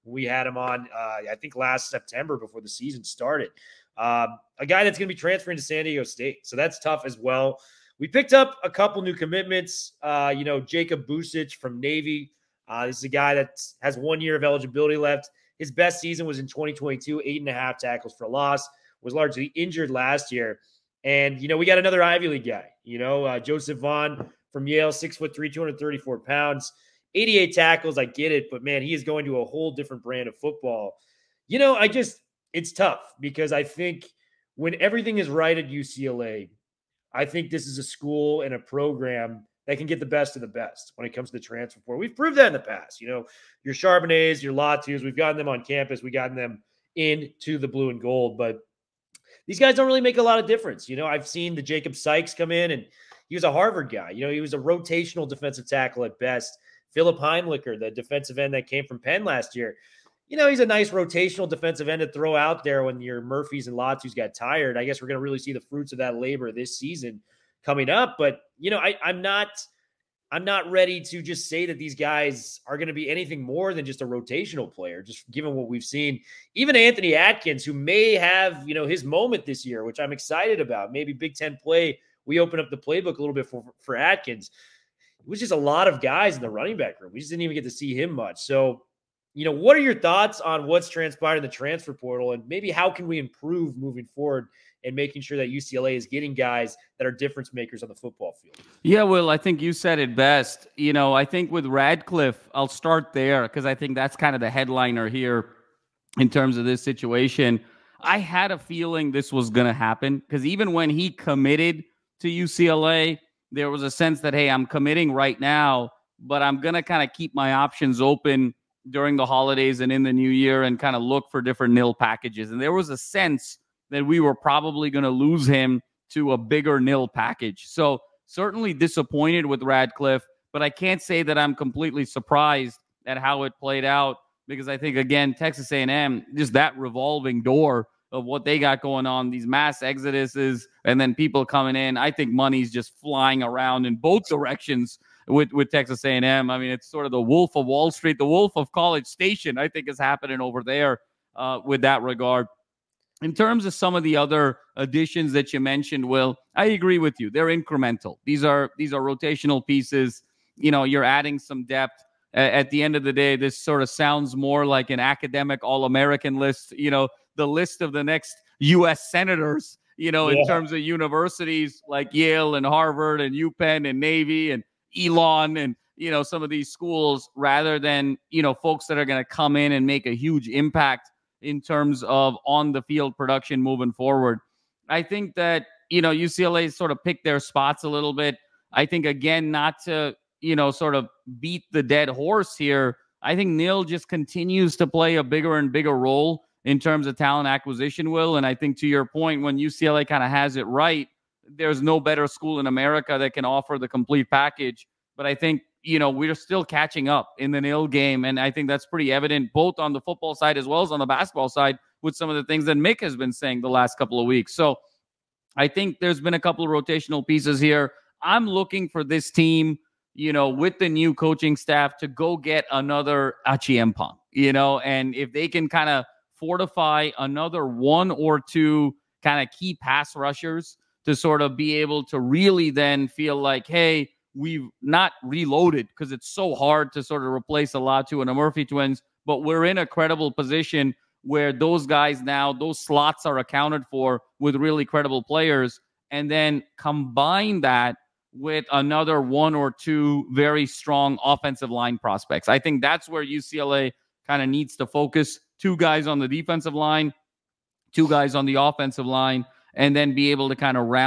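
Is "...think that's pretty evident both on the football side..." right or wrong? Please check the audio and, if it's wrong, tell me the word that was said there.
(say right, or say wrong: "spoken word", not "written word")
right.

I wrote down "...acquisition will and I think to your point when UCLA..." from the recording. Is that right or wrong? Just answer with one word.
right.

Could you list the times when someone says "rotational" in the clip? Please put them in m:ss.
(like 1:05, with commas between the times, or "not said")
0:54, 1:00, 1:14, 2:39, 3:36.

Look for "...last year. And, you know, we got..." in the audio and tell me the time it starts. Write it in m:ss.
0:19.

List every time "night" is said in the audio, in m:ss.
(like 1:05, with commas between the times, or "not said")
not said.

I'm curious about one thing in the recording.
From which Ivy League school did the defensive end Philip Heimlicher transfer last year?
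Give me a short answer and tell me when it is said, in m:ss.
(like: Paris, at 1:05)
Penn, at 0:58.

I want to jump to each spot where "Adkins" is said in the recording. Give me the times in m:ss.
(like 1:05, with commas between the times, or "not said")
1:17, 1:23.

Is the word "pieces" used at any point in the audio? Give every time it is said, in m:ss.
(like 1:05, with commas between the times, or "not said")
2:39, 3:37.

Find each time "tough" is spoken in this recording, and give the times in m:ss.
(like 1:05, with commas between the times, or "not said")
0:06, 0:32.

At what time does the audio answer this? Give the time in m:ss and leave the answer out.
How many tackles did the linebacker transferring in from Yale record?
0:27.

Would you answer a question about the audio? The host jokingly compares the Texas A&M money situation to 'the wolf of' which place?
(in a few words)
College Station.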